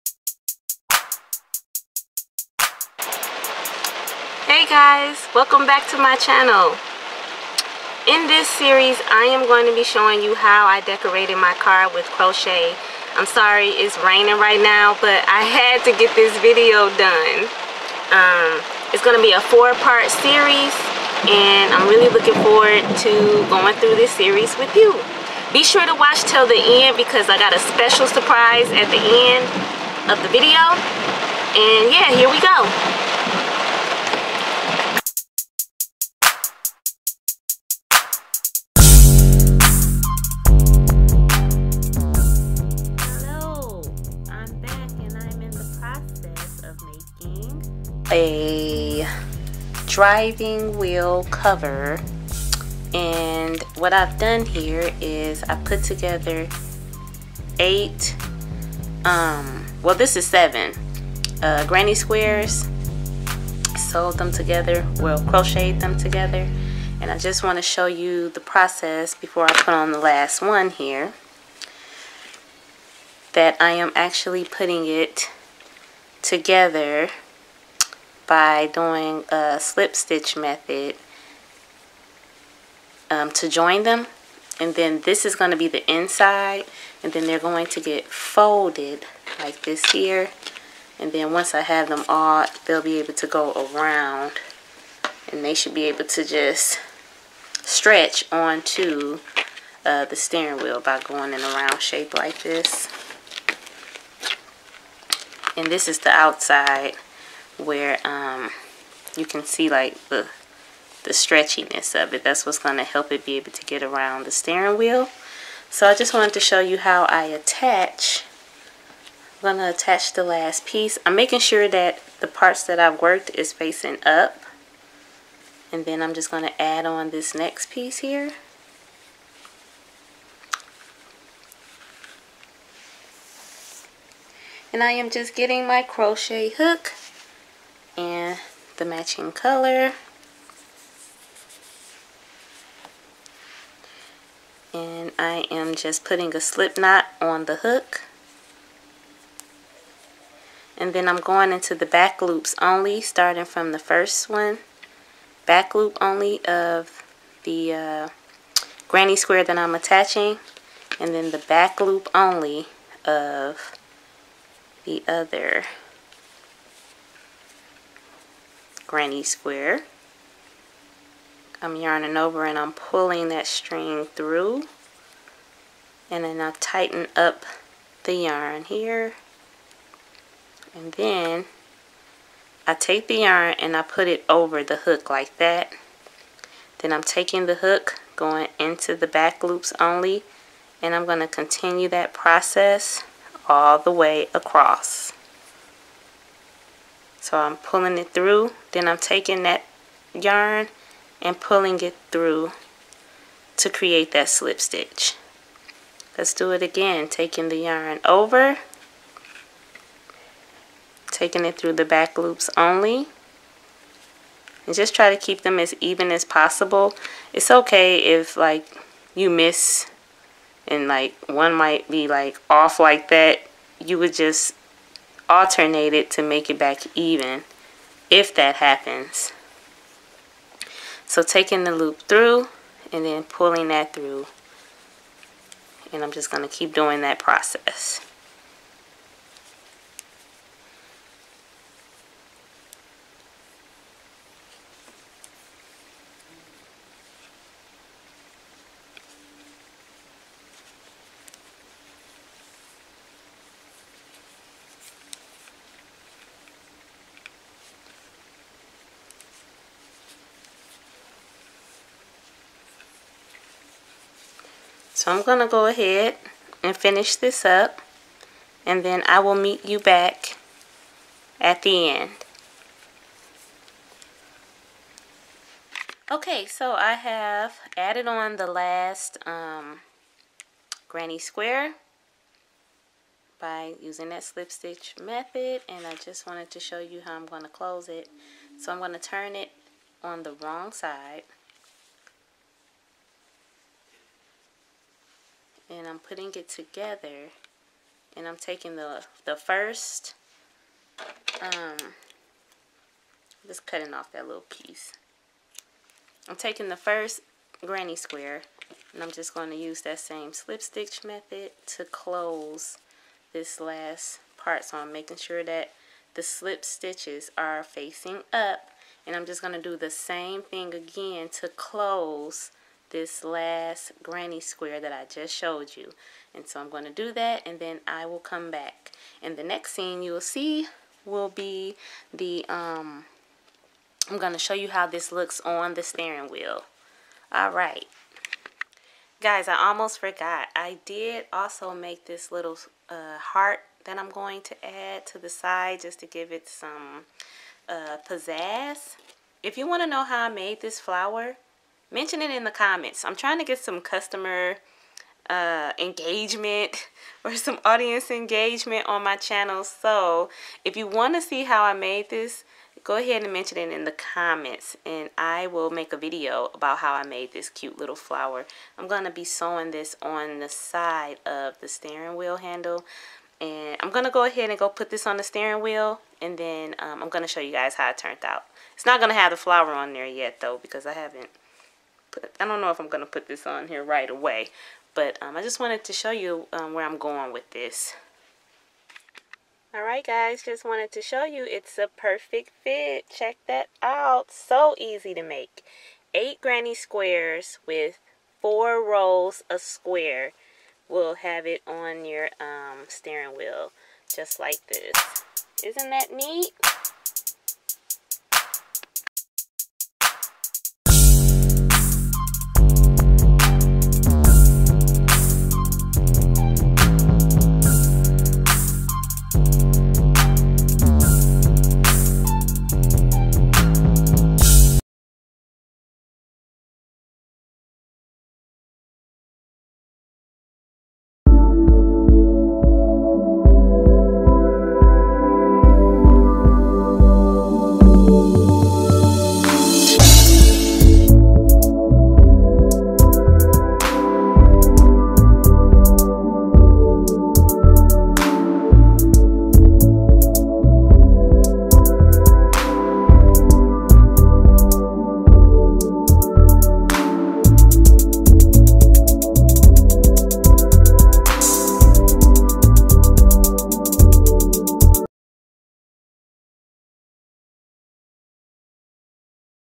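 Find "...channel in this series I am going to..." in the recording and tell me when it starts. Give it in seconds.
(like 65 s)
6 s.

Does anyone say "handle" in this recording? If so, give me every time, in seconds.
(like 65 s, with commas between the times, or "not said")
372 s.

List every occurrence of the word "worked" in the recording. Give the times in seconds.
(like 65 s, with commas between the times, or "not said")
123 s.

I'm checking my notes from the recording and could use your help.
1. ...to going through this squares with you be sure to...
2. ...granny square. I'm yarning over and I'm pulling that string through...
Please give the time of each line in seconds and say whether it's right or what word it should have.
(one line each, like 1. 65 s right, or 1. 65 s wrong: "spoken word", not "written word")
1. 23 s wrong: "series", not "squares"
2. 168 s right.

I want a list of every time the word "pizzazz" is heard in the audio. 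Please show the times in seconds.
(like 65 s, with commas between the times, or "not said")
348 s.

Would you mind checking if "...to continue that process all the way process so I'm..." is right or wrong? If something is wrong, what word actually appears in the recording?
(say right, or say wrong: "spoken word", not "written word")
wrong: "across", not "process".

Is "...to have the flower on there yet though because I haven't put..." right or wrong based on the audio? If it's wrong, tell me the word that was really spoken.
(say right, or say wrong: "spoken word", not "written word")
right.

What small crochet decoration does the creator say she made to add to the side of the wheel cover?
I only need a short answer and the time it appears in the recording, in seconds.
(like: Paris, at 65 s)
heart, at 343 s.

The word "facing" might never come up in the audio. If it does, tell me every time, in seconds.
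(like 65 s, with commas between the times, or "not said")
123 s, 317 s.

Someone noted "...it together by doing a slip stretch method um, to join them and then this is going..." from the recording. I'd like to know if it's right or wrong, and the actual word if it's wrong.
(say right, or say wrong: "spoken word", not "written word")
wrong: "stitch", not "stretch".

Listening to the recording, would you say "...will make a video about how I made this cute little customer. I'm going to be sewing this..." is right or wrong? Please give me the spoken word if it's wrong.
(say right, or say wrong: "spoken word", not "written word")
wrong: "flower", not "customer".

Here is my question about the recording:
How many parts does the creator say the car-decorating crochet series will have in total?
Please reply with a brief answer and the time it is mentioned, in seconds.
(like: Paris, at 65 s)
4, at 19 s.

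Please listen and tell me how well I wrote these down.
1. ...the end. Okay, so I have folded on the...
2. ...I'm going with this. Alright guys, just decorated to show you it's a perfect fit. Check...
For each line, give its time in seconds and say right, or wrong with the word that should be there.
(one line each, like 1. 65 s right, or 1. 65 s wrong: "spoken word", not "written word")
1. 271 s wrong: "added", not "folded"
2. 386 s wrong: "wanted", not "decorated".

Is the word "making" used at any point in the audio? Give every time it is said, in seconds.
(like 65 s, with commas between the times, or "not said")
121 s, 314 s.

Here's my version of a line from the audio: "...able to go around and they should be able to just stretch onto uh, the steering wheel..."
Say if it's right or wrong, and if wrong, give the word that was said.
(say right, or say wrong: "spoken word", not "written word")
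right.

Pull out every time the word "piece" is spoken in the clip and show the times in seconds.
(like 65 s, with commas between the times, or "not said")
120 s, 127 s, 304 s.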